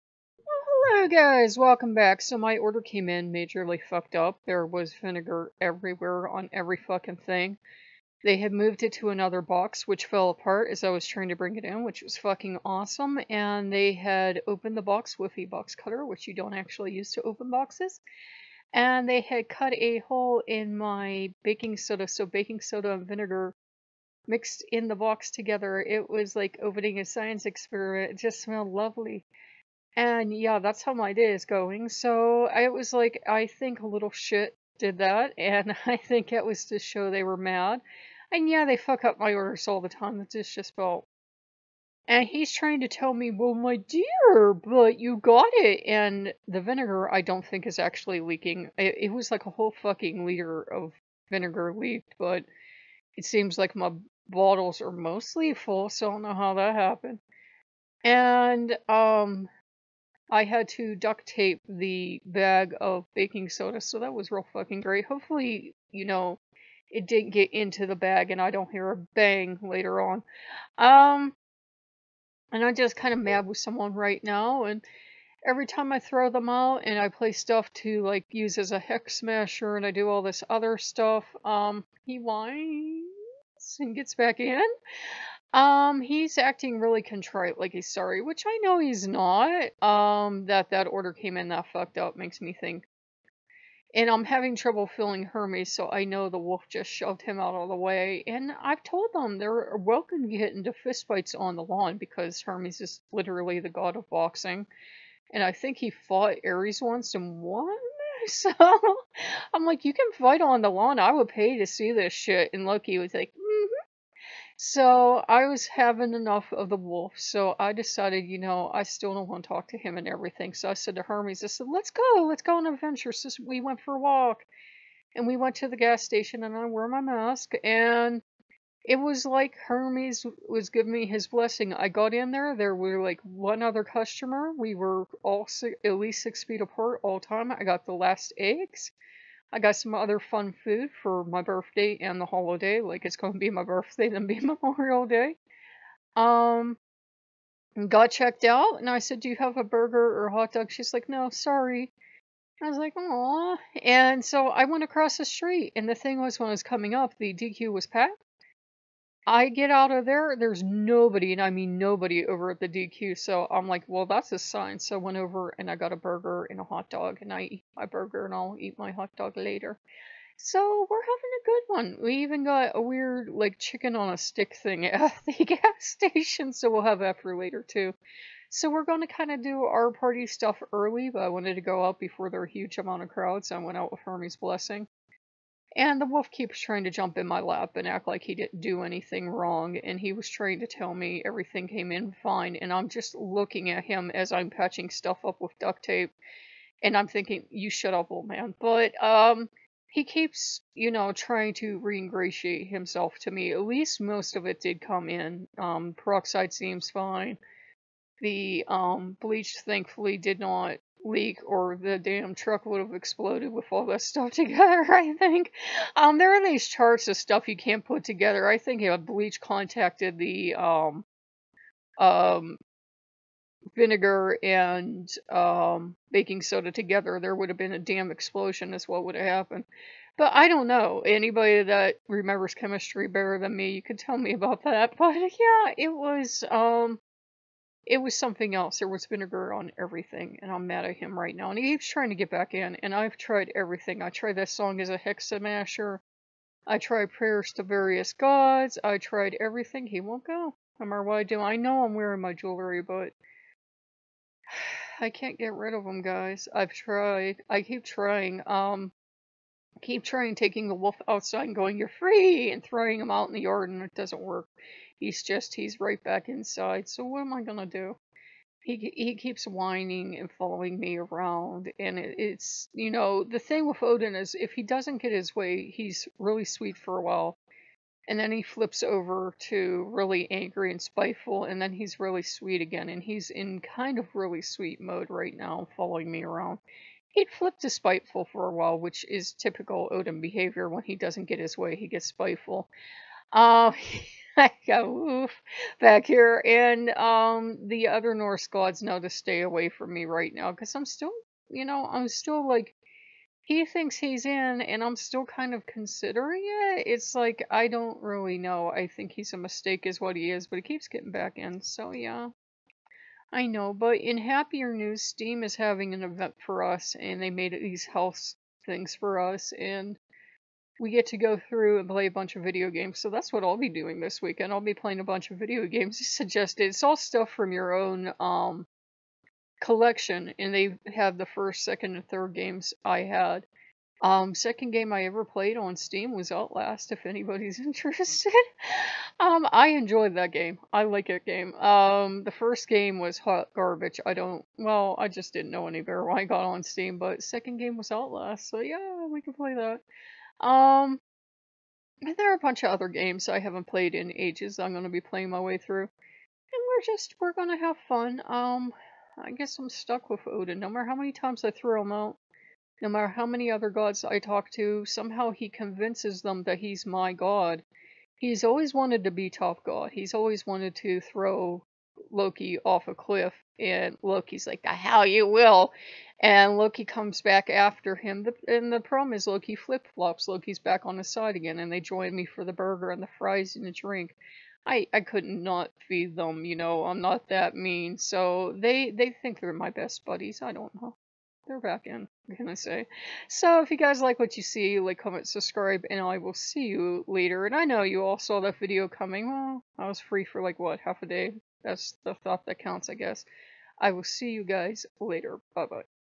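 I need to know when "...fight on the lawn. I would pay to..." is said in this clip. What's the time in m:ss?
1:50.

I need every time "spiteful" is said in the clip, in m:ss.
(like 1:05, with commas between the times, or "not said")
4:40, 4:47, 4:52.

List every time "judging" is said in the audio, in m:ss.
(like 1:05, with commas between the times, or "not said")
not said.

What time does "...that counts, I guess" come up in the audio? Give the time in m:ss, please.
6:42.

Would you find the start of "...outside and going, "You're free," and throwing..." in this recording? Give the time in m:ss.
4:21.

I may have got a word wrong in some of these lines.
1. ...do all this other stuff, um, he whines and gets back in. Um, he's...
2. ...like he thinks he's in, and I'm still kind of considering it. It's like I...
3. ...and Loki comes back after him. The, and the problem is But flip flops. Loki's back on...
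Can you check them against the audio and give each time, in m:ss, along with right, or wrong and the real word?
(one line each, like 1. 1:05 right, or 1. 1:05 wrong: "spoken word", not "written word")
1. 1:19 right
2. 5:02 right
3. 6:16 wrong: "Loki", not "But".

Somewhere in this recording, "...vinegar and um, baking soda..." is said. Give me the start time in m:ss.
3:43.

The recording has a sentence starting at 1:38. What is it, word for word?
And I've told them they're welcome to get into fistfights on the lawn because Hermes is literally the god of boxing.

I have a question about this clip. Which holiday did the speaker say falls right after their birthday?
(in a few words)
Memorial Day.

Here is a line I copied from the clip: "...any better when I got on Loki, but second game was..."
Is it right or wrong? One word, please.
wrong.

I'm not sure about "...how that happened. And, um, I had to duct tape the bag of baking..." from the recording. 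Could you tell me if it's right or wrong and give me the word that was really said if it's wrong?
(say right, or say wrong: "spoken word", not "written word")
right.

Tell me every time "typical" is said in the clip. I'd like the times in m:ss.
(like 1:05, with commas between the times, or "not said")
4:49.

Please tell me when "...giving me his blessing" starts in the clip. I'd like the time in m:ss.
2:10.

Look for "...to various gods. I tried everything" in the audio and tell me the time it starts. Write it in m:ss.
4:07.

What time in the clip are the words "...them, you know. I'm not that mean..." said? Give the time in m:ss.
6:26.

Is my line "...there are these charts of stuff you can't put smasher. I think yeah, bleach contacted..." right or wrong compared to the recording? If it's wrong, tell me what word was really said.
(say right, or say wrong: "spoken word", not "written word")
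wrong: "together", not "smasher".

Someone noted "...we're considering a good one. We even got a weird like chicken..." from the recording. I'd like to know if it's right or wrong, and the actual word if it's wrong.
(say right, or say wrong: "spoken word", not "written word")
wrong: "having", not "considering".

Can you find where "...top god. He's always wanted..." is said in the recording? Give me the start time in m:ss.
6:09.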